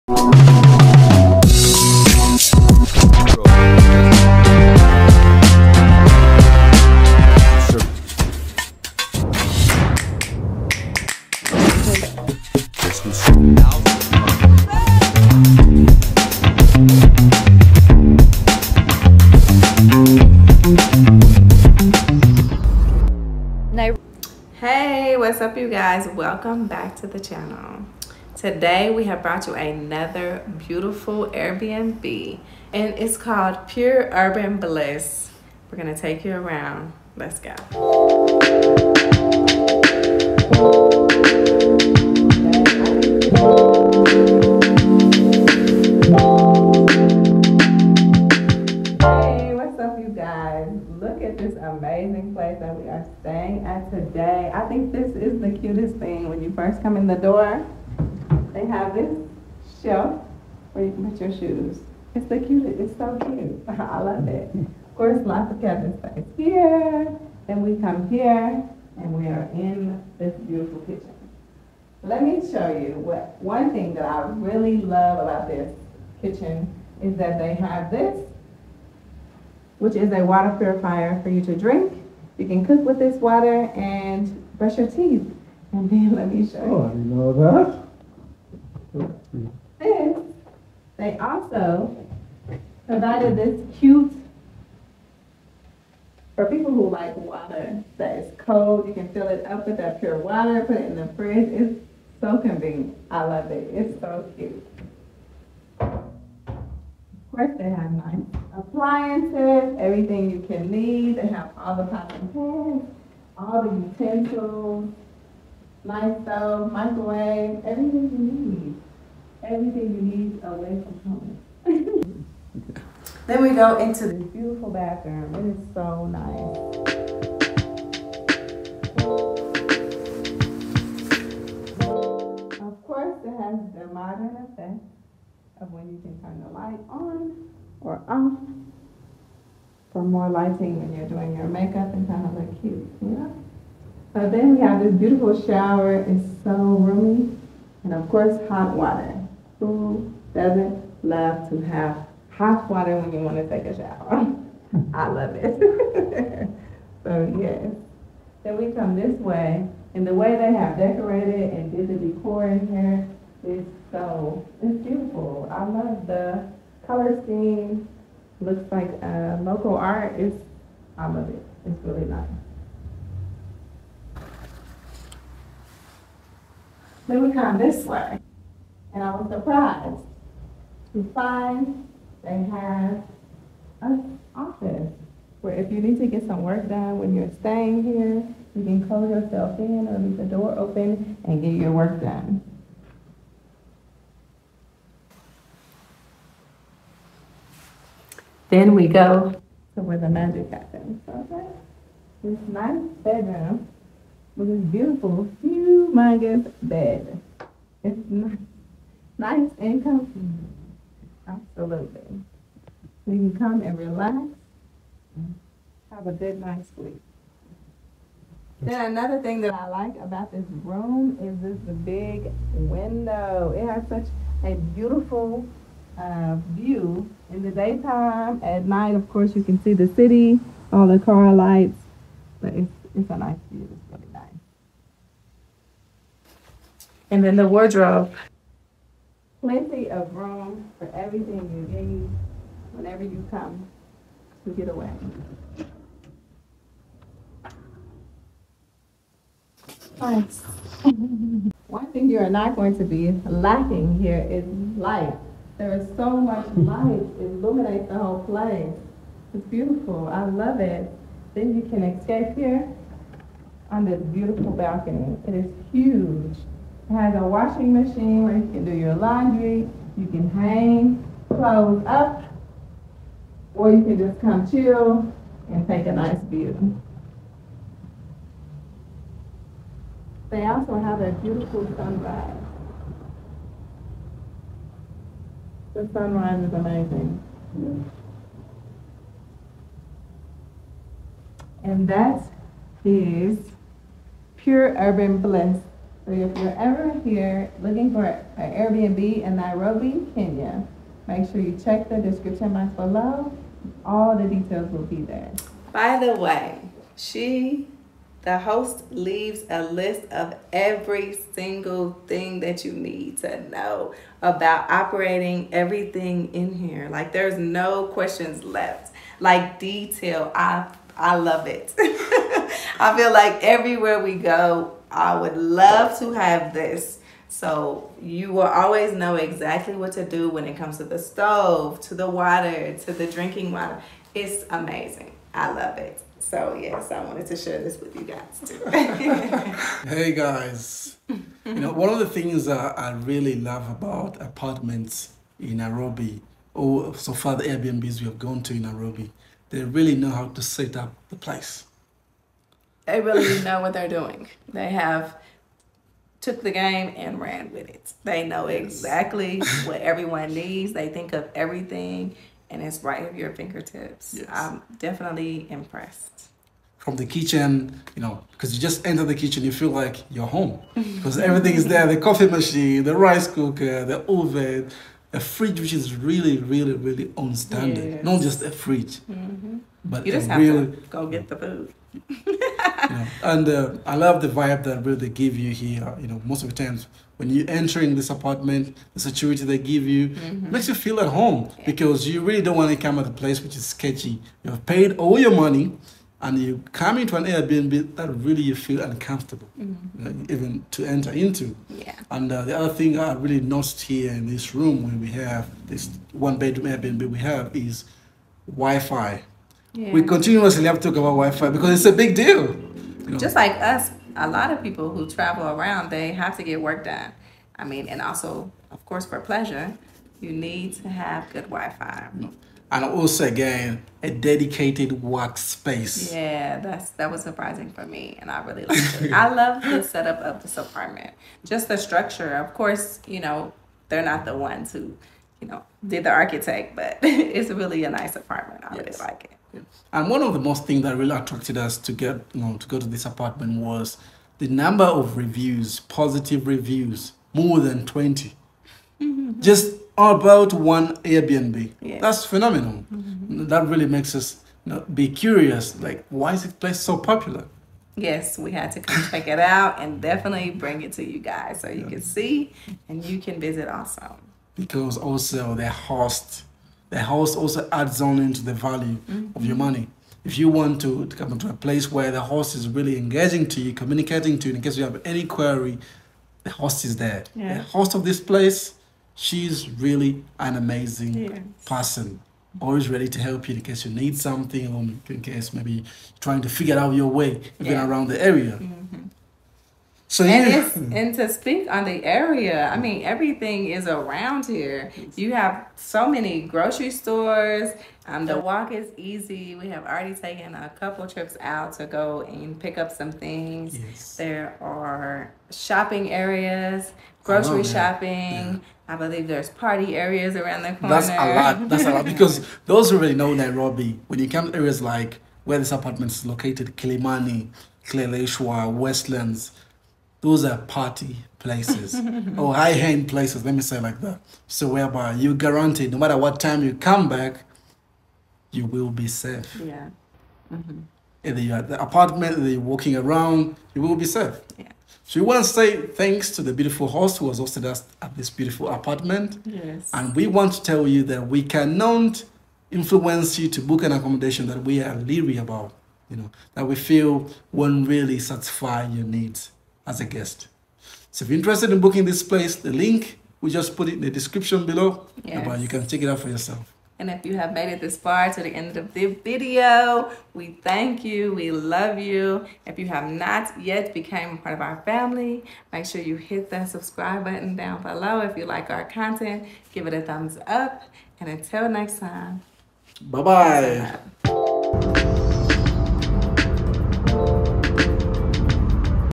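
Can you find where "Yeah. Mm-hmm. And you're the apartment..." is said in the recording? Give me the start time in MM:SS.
08:49.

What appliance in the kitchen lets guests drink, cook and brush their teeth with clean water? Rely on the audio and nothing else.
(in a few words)
A water purifier.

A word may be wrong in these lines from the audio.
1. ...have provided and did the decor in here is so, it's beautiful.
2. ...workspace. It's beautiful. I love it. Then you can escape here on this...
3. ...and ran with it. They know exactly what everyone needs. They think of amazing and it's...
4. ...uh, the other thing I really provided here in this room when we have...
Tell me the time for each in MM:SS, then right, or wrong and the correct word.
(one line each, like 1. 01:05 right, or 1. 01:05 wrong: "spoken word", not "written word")
1. 02:40 wrong: "decorated", not "provided"
2. 04:18 wrong: "place", not "workspace"
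3. 05:56 wrong: "everything", not "amazing"
4. 06:42 wrong: "noticed", not "provided".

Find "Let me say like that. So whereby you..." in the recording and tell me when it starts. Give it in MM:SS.
08:43.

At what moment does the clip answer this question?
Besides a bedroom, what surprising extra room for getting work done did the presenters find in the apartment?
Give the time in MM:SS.
03:04.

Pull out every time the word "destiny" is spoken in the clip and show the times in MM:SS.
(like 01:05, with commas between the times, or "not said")
not said.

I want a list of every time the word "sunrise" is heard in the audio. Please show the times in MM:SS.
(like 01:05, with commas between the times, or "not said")
04:41, 04:45.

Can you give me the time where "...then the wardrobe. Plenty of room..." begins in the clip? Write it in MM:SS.
03:57.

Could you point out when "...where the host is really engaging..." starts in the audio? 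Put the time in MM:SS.
07:51.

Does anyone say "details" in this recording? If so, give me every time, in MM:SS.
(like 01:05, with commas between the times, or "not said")
05:04, 05:19.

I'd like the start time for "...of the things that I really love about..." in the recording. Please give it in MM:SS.
05:41.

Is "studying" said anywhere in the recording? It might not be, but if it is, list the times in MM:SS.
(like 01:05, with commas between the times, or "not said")
not said.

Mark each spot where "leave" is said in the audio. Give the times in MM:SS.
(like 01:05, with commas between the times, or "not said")
03:09, 05:08.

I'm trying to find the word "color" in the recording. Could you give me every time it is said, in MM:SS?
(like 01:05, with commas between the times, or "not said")
02:46.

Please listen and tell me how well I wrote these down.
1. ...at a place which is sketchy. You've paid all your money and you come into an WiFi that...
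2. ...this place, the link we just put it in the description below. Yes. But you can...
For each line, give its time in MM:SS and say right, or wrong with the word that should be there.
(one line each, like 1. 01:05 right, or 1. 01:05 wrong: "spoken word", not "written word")
1. 06:32 wrong: "Airbnb", not "WiFi"
2. 09:12 right.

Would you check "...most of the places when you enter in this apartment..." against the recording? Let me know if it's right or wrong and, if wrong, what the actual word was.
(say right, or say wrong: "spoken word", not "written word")
wrong: "times", not "places".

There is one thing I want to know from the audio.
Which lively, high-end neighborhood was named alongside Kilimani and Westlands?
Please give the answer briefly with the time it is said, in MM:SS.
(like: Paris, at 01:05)
Kileleshwa, at 08:37.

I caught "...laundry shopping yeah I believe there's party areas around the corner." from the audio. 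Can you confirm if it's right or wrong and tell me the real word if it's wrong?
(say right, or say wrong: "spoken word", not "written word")
wrong: "grocery", not "laundry".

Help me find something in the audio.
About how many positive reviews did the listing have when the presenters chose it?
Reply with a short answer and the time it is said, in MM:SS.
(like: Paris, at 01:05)
More than 20, at 07:27.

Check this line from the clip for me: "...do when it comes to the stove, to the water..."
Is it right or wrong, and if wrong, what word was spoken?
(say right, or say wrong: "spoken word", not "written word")
right.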